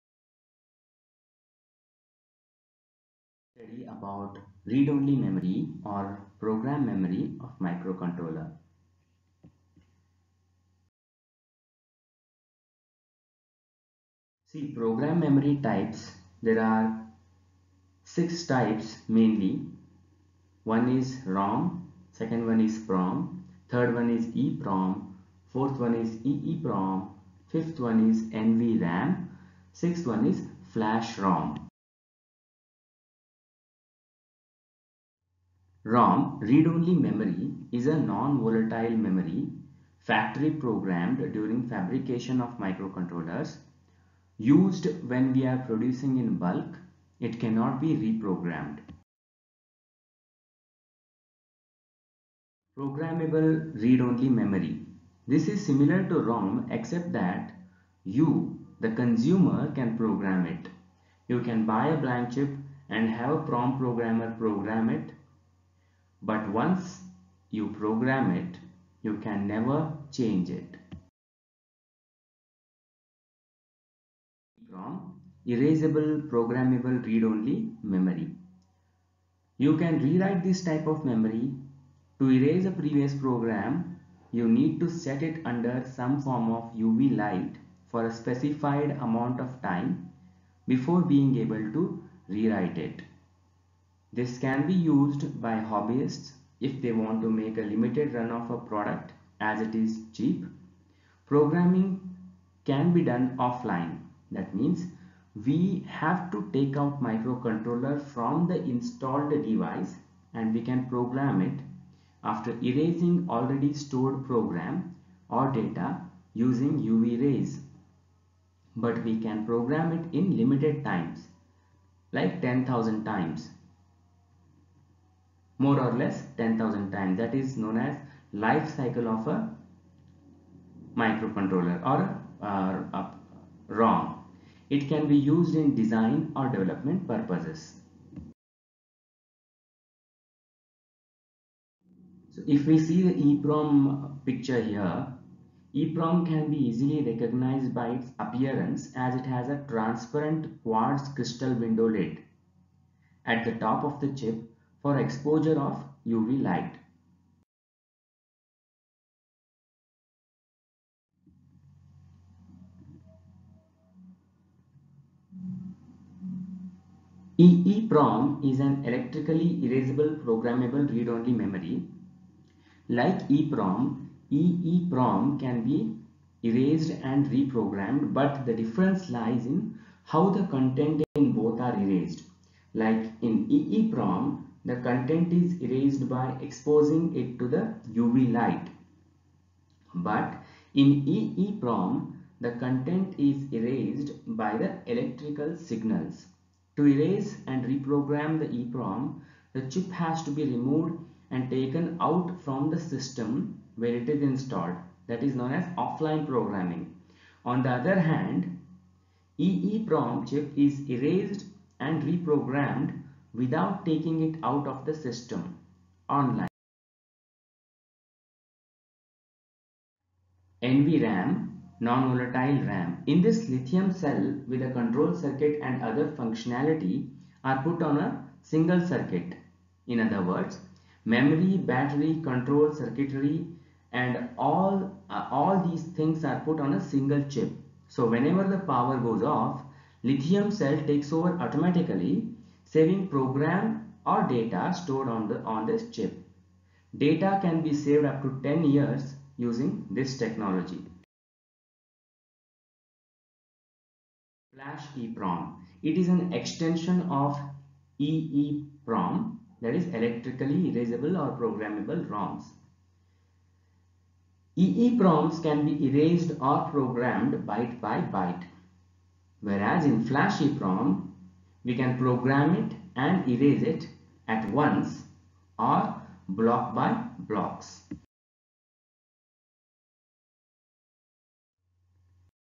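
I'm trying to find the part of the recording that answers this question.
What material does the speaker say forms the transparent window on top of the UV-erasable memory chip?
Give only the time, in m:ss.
2:30.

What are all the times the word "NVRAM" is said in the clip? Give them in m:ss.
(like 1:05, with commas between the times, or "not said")
0:28, 3:40.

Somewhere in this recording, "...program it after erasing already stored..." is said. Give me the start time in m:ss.
1:50.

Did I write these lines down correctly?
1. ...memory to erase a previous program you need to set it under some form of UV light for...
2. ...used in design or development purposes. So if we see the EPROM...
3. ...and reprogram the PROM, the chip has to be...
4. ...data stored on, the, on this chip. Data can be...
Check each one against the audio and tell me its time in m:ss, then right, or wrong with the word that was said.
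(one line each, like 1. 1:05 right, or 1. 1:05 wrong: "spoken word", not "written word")
1. 1:21 right
2. 2:15 right
3. 3:17 wrong: "EPROM", not "PROM"
4. 4:04 right.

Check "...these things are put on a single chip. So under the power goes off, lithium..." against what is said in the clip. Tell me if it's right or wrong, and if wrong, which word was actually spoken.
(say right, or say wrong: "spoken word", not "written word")
wrong: "whenever", not "under".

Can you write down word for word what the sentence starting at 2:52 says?
Like EPROM, EEPROM can be erased and reprogrammed but the difference lies in how the content in both are erased.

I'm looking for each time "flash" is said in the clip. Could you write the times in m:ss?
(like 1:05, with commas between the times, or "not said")
0:30, 4:14, 4:30.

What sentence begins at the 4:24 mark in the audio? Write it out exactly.
EEPROMs can be erased or programmed byte by byte.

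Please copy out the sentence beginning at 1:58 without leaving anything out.
But we can program it in limited times like 10,000 times more or less 10,000 times.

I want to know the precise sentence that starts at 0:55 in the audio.
This is similar to ROM except that you, the consumer, can program it.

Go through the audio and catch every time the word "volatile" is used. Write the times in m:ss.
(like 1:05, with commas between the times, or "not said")
0:37, 3:41.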